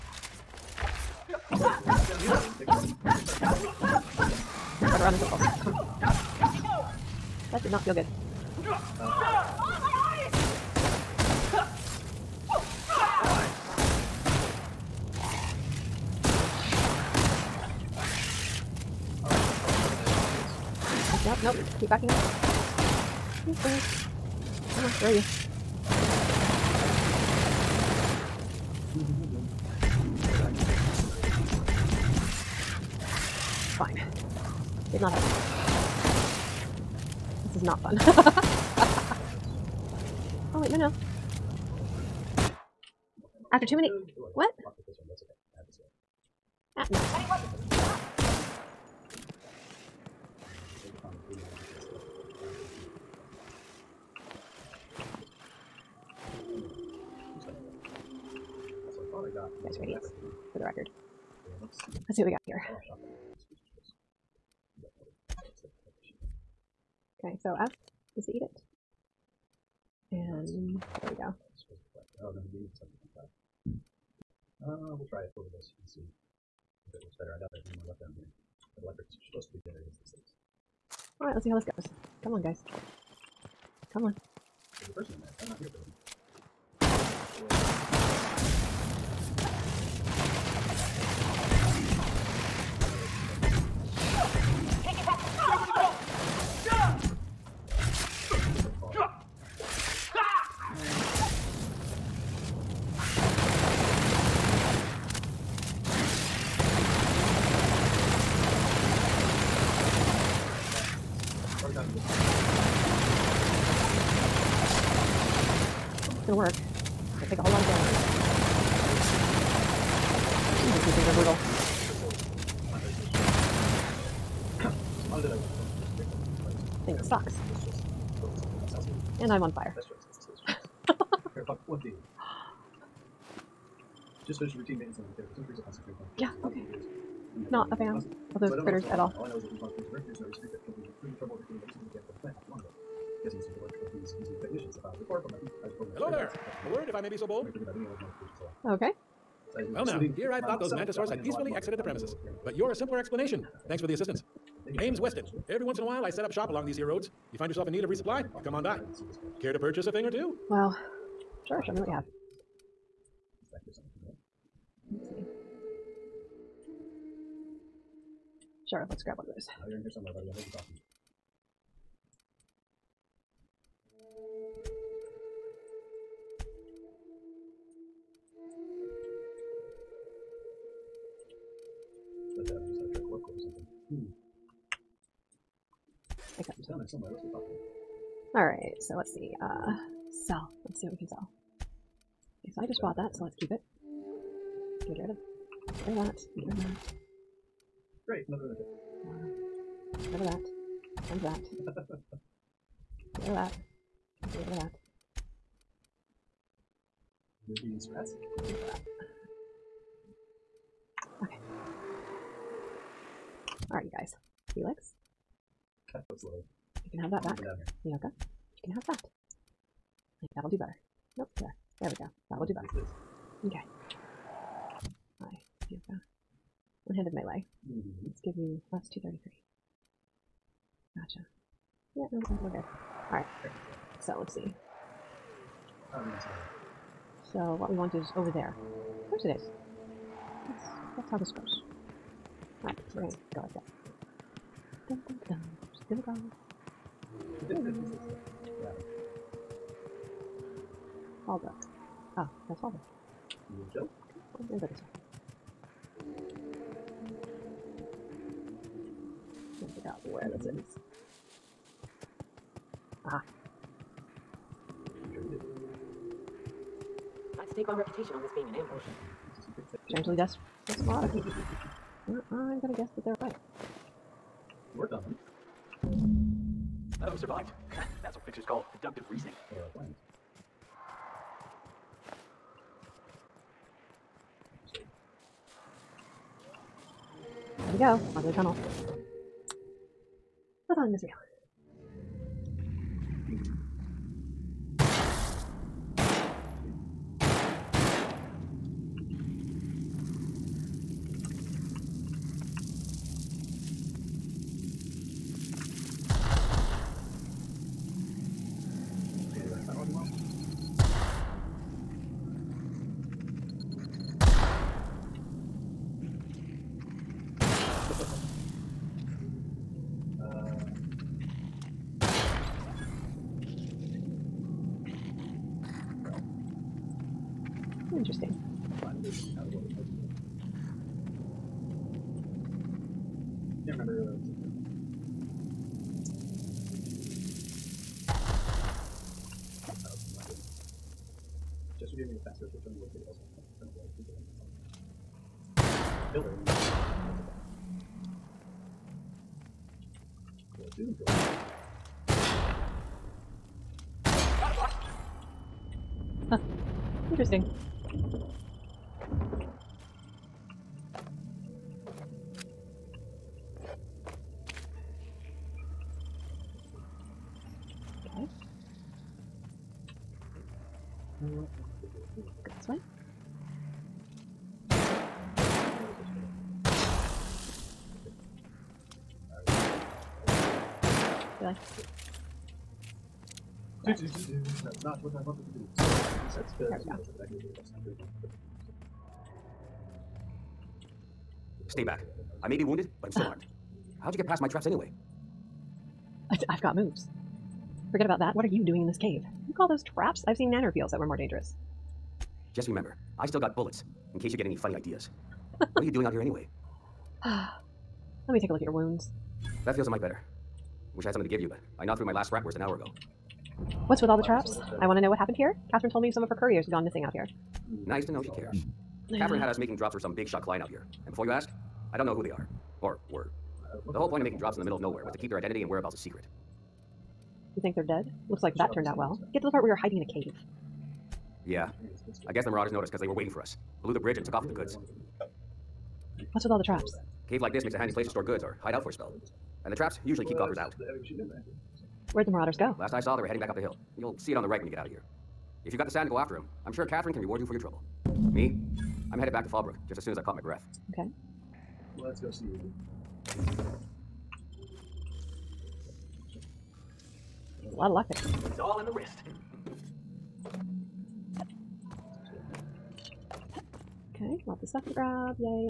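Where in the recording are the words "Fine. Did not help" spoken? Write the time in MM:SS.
00:33.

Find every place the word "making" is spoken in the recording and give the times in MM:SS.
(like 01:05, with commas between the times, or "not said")
06:59, 07:04.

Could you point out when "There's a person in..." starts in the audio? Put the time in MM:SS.
01:24.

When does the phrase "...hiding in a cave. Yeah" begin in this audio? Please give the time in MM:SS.
07:09.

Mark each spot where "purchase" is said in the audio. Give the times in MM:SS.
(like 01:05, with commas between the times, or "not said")
02:39.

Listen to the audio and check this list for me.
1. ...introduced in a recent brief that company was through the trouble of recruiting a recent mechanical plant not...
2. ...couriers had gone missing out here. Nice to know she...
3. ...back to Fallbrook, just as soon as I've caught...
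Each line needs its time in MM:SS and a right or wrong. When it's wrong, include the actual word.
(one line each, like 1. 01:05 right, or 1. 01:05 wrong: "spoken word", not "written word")
1. 02:19 right
2. 06:56 right
3. 07:29 right.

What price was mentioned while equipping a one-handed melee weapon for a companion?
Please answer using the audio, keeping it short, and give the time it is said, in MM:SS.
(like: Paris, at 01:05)
233, at 03:48.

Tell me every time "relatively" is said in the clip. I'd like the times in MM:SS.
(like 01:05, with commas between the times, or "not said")
not said.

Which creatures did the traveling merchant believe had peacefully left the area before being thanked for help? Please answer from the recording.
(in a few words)
mantisaurs.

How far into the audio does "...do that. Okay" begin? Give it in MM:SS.
03:42.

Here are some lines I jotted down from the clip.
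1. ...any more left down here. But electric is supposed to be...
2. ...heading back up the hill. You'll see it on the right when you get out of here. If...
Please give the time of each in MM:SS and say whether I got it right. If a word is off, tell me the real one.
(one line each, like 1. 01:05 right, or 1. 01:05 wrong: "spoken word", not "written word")
1. 01:17 right
2. 07:23 right.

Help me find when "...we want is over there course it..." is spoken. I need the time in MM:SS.
03:57.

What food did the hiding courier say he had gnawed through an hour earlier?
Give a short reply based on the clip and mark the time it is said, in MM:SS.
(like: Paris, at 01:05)
Spratwurst, at 06:52.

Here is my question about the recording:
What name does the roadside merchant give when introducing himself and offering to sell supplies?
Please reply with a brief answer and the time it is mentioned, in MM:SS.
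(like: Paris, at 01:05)
Weston, at 02:34.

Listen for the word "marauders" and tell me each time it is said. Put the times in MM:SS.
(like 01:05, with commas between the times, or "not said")
07:12, 07:22.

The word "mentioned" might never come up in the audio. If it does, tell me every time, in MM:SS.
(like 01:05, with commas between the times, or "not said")
not said.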